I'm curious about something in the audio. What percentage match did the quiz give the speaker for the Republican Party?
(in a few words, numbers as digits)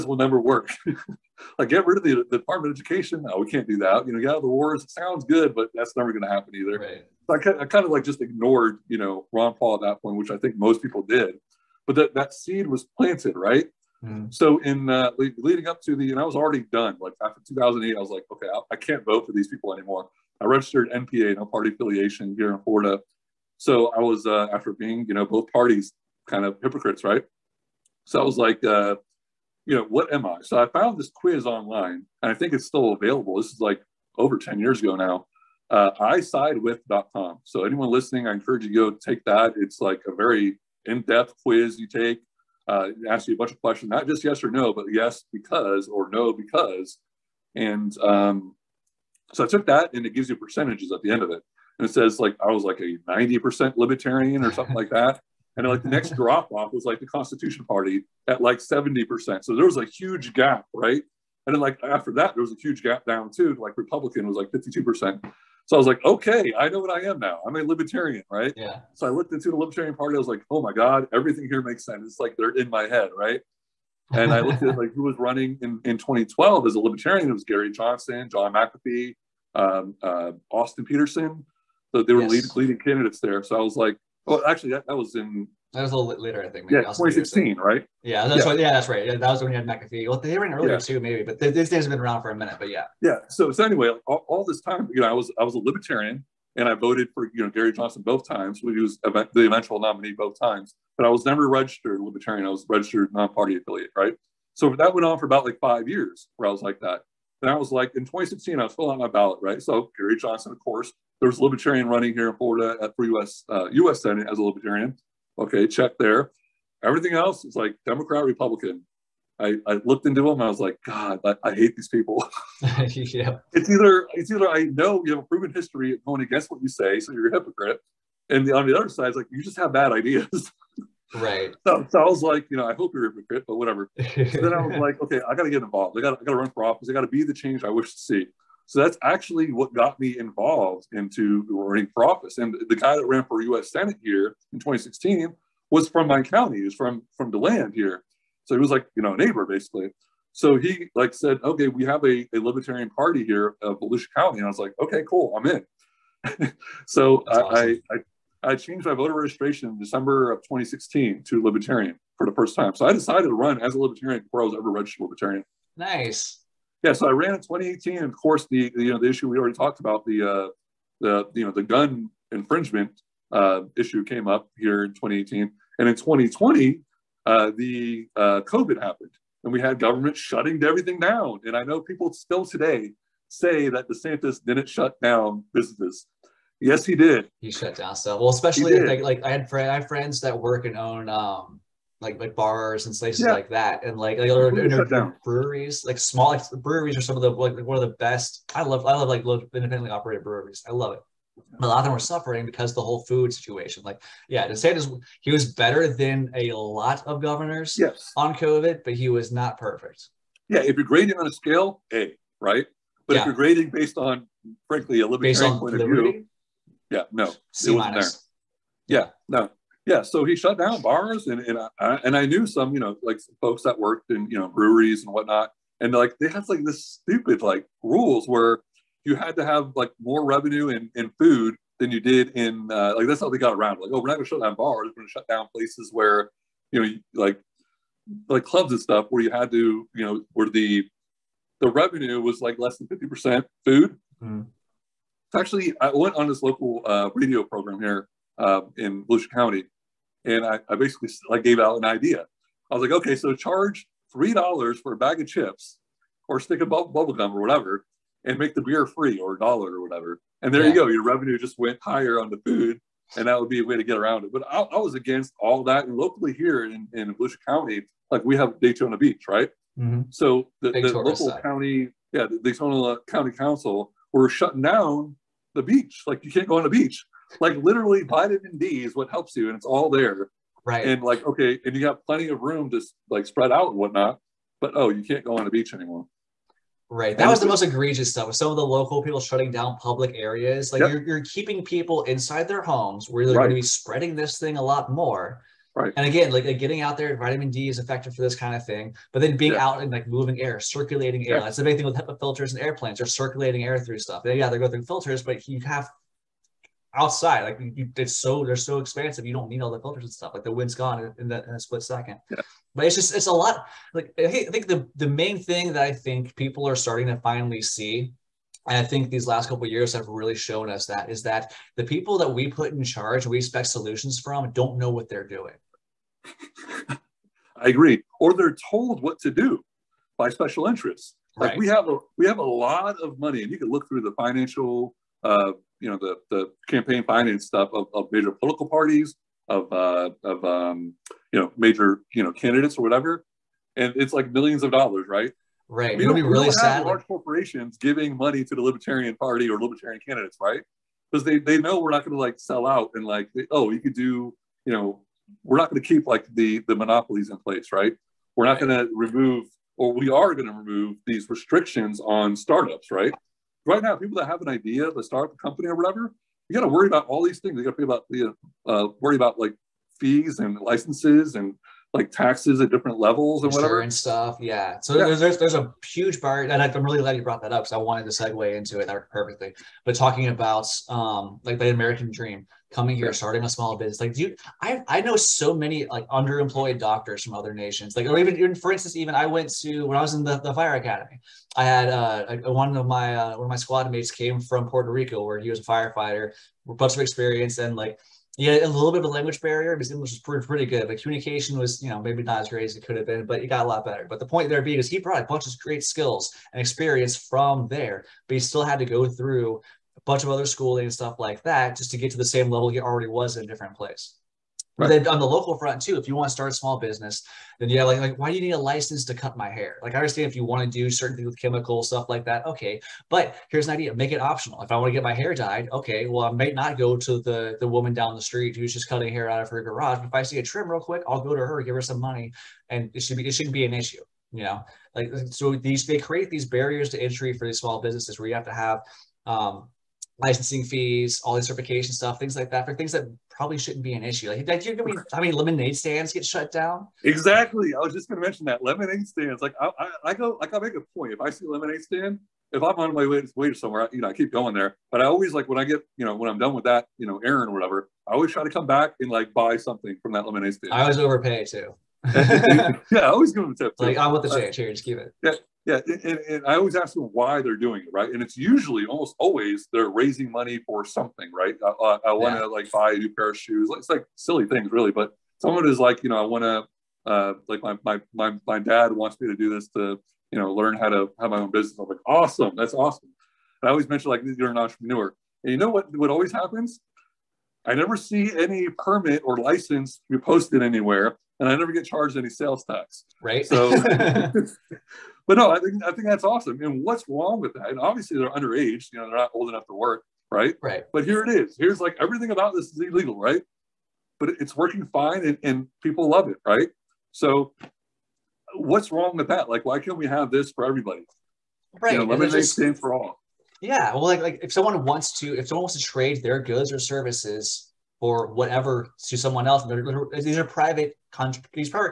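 52%.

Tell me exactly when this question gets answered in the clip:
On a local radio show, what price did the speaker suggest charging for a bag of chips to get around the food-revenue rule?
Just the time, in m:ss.
4:14.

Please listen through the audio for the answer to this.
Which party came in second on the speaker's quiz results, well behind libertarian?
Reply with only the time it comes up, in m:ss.
0:57.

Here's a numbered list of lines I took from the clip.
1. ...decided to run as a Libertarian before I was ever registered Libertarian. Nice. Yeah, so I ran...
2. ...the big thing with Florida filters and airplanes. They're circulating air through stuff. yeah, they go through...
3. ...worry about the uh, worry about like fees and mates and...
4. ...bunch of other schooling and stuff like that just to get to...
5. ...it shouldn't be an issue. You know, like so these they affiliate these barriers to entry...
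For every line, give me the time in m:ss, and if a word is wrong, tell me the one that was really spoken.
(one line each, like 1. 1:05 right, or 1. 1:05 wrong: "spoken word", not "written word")
1. 2:42 right
2. 5:01 wrong: "HEPA", not "Florida"
3. 6:07 wrong: "licenses", not "mates"
4. 6:50 right
5. 7:13 wrong: "create", not "affiliate".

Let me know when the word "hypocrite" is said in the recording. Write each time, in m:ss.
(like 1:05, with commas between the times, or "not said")
0:26, 2:07, 2:13.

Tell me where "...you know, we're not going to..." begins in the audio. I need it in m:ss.
5:54.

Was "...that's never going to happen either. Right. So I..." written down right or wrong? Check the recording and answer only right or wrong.
right.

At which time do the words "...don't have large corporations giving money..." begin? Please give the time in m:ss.
5:46.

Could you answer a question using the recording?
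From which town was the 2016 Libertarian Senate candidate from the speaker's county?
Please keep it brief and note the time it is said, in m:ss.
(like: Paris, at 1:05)
DeLand, at 2:27.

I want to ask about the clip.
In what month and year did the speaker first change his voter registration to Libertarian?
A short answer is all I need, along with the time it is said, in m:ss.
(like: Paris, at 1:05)
December 2016, at 2:39.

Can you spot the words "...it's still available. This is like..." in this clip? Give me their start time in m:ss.
0:32.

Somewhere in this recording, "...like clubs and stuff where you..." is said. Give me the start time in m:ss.
3:58.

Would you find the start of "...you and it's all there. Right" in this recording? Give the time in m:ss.
4:39.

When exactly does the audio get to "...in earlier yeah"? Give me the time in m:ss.
1:30.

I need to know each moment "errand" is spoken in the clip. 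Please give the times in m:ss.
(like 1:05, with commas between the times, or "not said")
7:37.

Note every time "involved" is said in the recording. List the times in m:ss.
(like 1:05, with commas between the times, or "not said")
2:15, 2:20.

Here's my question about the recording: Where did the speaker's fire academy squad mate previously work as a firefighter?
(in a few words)
Puerto Rico.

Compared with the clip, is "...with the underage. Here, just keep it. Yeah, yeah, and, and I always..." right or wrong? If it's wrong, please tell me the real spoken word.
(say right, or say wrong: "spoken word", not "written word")
wrong: "change", not "underage".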